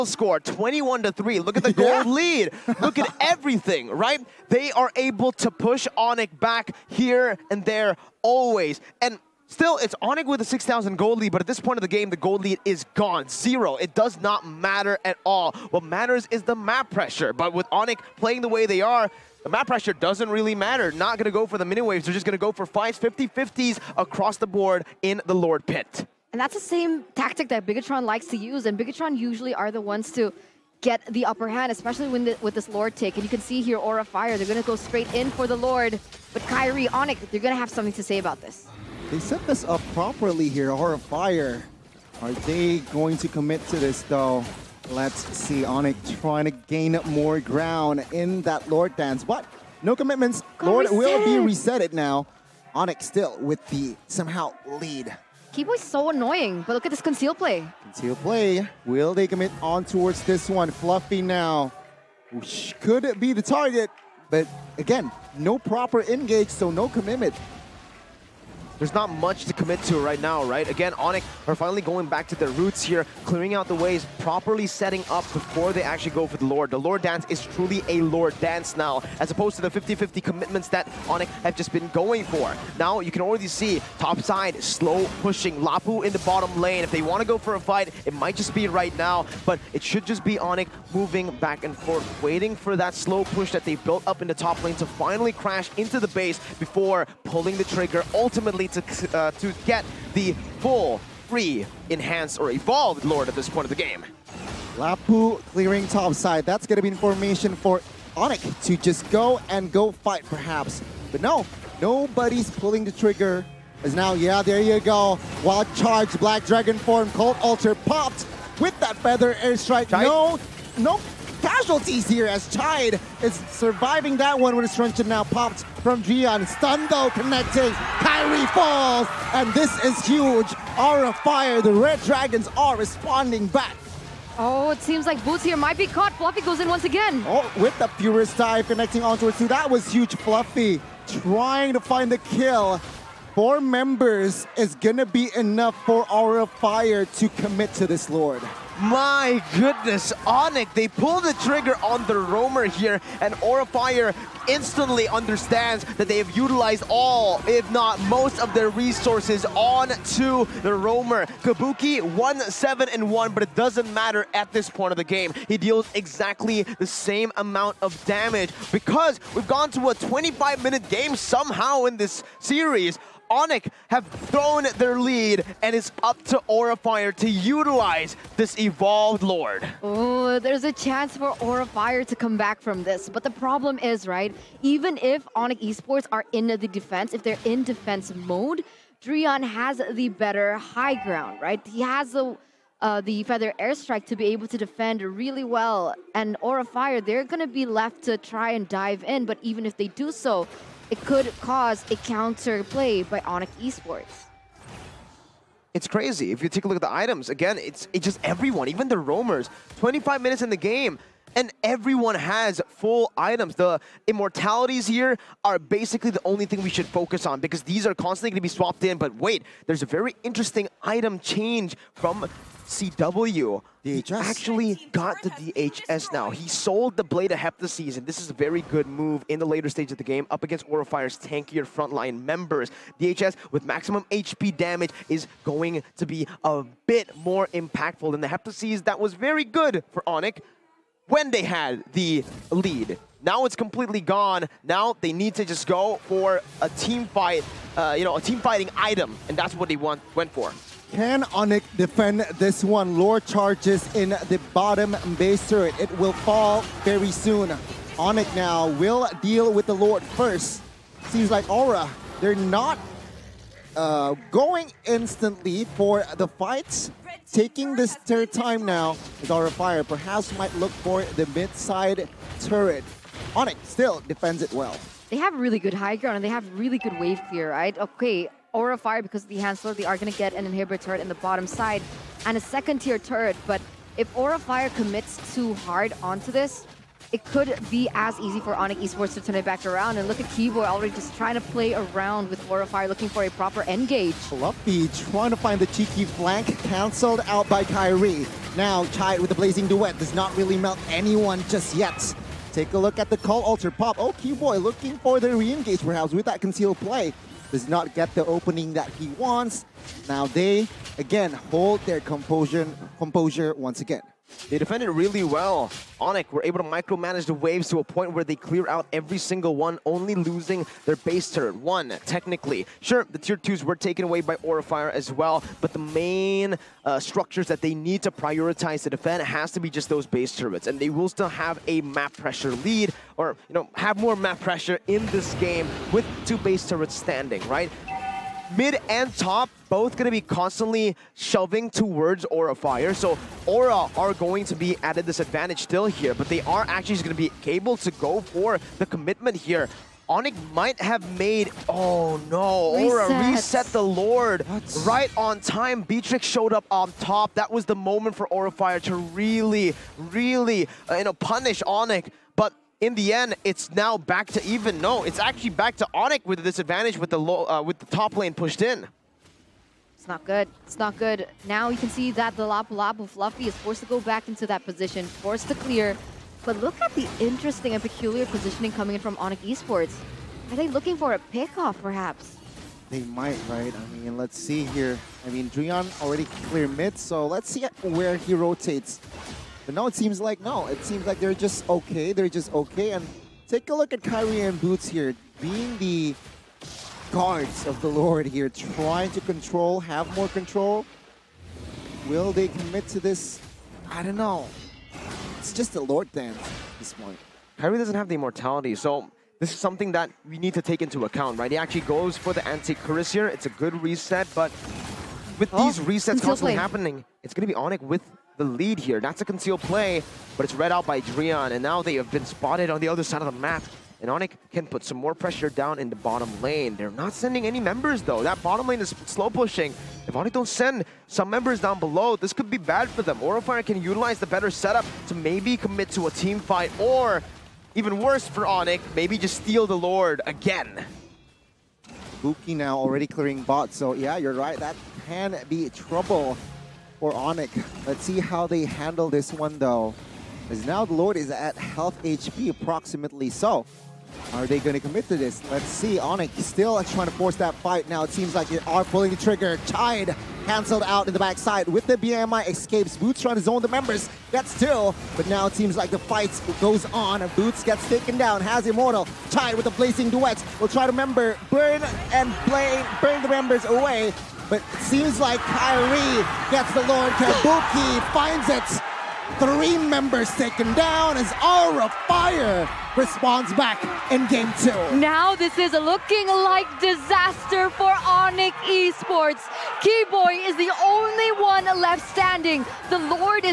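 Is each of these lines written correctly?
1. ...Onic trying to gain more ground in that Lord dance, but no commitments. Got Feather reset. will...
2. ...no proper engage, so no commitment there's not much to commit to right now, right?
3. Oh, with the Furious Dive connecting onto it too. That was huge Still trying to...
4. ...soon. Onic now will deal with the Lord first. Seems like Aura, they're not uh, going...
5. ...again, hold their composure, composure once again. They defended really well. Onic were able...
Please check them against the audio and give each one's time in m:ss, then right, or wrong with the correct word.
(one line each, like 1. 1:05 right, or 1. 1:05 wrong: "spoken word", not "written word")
1. 0:45 wrong: "Lord", not "Feather"
2. 1:05 right
3. 2:17 wrong: "Fluffy", not "Still"
4. 4:17 right
5. 5:10 right.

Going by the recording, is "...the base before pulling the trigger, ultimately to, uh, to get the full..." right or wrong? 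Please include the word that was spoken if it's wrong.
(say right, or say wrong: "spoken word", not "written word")
right.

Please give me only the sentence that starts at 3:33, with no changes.
The immortalities here are basically the only thing we should focus on because these are constantly going to be swapped in.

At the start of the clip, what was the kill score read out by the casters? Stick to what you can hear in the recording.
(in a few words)
21 to 3.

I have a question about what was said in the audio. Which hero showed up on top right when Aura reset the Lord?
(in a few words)
Beatrix.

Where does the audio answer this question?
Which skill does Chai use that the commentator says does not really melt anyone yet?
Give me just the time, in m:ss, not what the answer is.
4:59.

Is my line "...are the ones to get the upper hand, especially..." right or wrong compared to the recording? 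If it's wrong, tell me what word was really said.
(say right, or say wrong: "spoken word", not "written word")
right.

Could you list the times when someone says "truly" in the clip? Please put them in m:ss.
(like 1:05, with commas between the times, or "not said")
1:17.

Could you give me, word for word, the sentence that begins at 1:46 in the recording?
That's going to be information for Onic to just go and go fight perhaps.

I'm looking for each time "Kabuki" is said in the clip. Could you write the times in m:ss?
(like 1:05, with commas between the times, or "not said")
2:41, 7:57.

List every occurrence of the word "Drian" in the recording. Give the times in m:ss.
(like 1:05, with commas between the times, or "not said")
6:25, 7:01.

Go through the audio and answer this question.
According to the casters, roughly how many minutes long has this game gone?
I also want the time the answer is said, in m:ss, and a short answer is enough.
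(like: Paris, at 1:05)
25 minutes, at 2:49.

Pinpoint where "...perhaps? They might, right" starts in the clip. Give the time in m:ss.
6:21.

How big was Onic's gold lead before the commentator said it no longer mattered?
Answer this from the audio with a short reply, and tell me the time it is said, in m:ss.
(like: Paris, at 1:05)
6,000 gold, at 0:10.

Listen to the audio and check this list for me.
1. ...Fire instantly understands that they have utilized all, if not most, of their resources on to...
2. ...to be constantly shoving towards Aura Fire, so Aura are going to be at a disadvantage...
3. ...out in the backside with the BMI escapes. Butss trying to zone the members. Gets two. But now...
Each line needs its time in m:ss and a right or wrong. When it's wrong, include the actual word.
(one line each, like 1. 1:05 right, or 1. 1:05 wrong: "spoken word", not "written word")
1. 2:33 right
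2. 5:40 right
3. 7:40 right.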